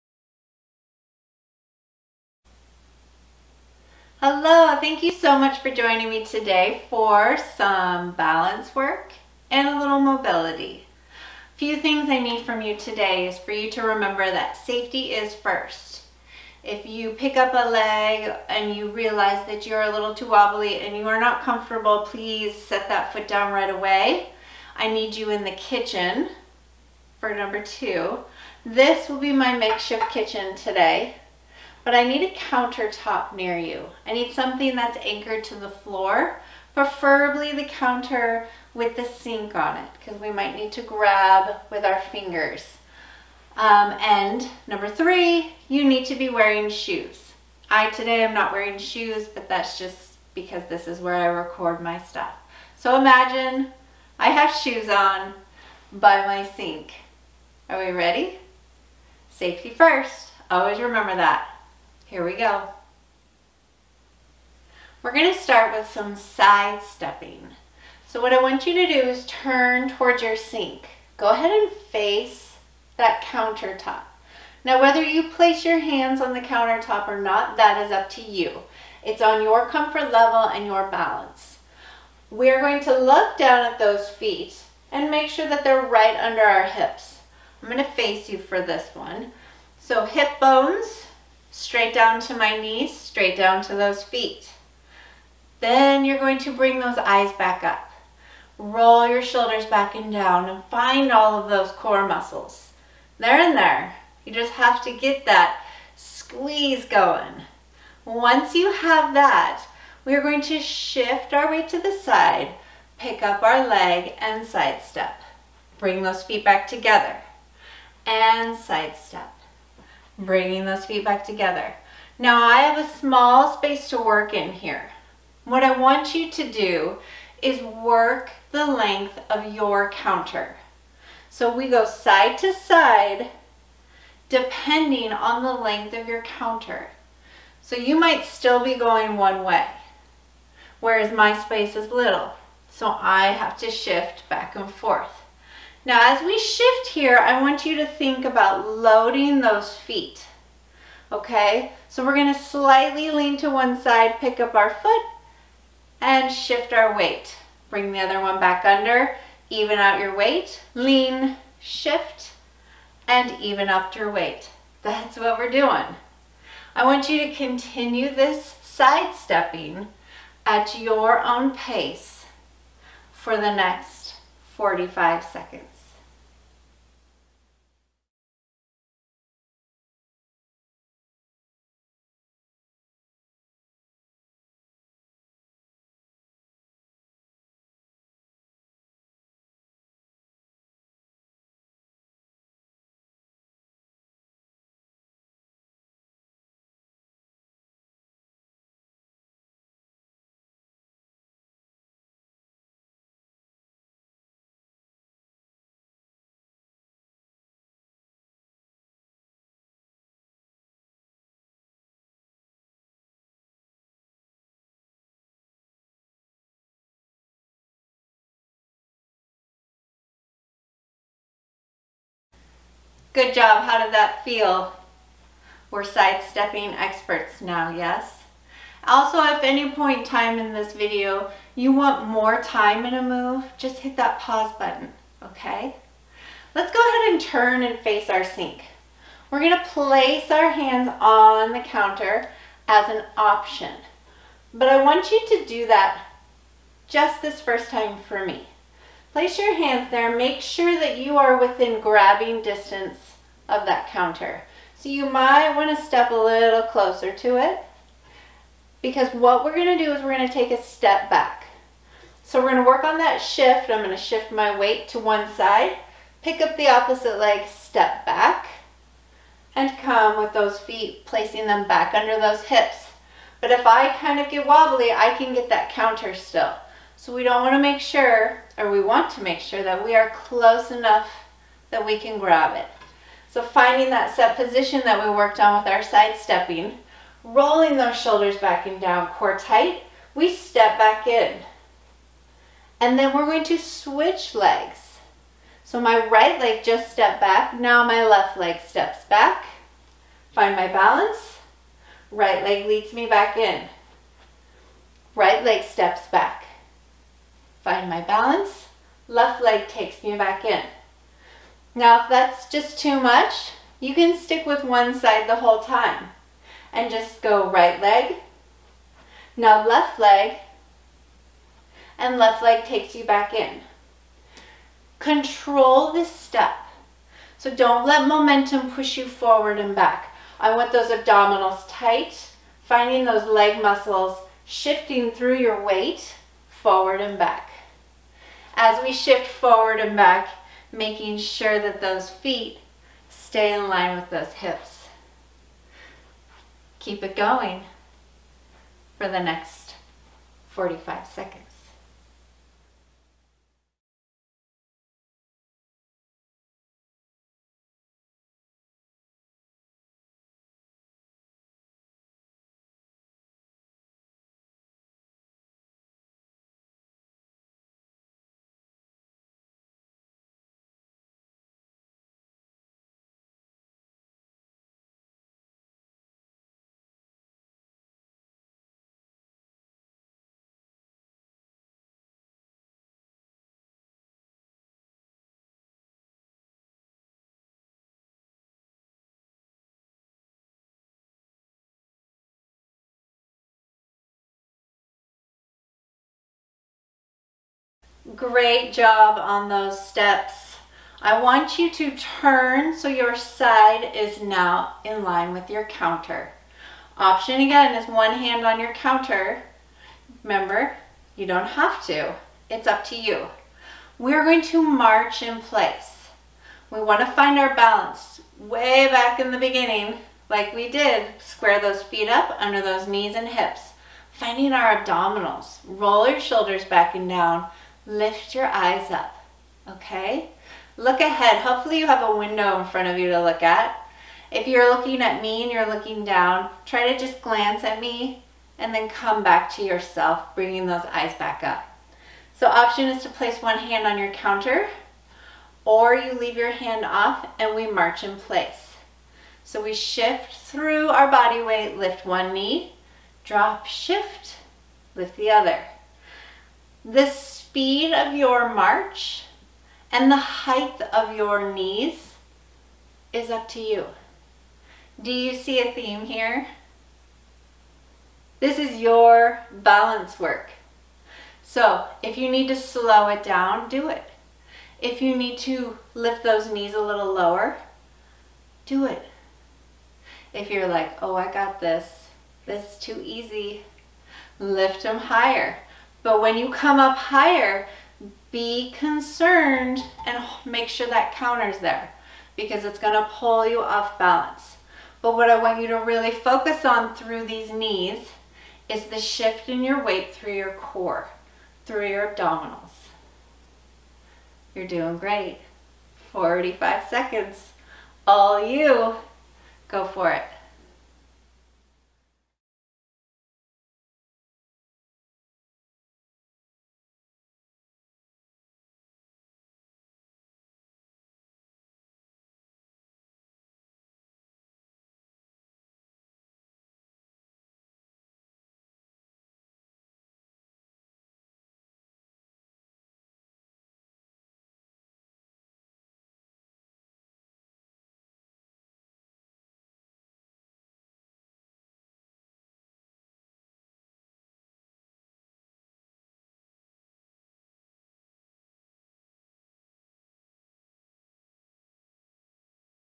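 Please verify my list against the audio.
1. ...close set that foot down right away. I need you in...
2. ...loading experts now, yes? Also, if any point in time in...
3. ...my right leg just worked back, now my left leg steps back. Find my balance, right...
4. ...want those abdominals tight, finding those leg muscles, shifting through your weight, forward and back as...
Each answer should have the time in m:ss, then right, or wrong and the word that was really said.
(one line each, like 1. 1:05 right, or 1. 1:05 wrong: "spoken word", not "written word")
1. 0:22 wrong: "please", not "close"
2. 3:45 wrong: "sidestepping", not "loading"
3. 4:55 wrong: "stepped", not "worked"
4. 5:30 right.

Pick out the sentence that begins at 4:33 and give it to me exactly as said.
But if I kind of get wobbly, I can get that counter still.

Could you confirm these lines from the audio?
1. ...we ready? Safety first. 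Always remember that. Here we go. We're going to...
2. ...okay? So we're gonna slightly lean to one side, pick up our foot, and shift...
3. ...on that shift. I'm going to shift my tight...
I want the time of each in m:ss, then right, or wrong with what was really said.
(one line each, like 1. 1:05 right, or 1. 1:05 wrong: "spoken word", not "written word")
1. 0:57 right
2. 2:31 right
3. 4:22 wrong: "weight", not "tight".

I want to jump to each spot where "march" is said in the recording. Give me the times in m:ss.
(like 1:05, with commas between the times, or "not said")
6:54, 7:27, 7:38.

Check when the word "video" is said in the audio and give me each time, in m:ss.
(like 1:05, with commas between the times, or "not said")
3:50.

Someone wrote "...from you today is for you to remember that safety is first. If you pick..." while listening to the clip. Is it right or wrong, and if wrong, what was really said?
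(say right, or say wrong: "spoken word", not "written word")
right.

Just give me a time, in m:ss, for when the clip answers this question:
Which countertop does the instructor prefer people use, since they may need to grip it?
0:37.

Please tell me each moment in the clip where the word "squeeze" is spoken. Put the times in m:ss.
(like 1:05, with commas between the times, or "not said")
1:45.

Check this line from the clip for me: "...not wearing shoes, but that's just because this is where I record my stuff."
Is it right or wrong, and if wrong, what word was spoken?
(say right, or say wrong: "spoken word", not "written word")
right.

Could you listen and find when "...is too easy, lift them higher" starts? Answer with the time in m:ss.
8:02.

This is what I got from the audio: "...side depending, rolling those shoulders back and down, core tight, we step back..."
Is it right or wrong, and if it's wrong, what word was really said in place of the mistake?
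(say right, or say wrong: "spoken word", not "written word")
wrong: "stepping", not "depending".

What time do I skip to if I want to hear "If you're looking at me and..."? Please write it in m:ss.
7:14.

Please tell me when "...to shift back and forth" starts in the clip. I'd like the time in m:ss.
2:23.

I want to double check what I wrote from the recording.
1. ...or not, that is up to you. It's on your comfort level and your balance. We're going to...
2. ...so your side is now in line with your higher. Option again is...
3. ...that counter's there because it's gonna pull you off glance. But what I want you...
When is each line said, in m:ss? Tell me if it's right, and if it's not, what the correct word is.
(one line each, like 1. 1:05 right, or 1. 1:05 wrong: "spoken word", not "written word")
1. 1:17 right
2. 6:42 wrong: "counter", not "higher"
3. 8:10 wrong: "balance", not "glance".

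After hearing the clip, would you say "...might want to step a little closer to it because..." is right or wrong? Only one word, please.
right.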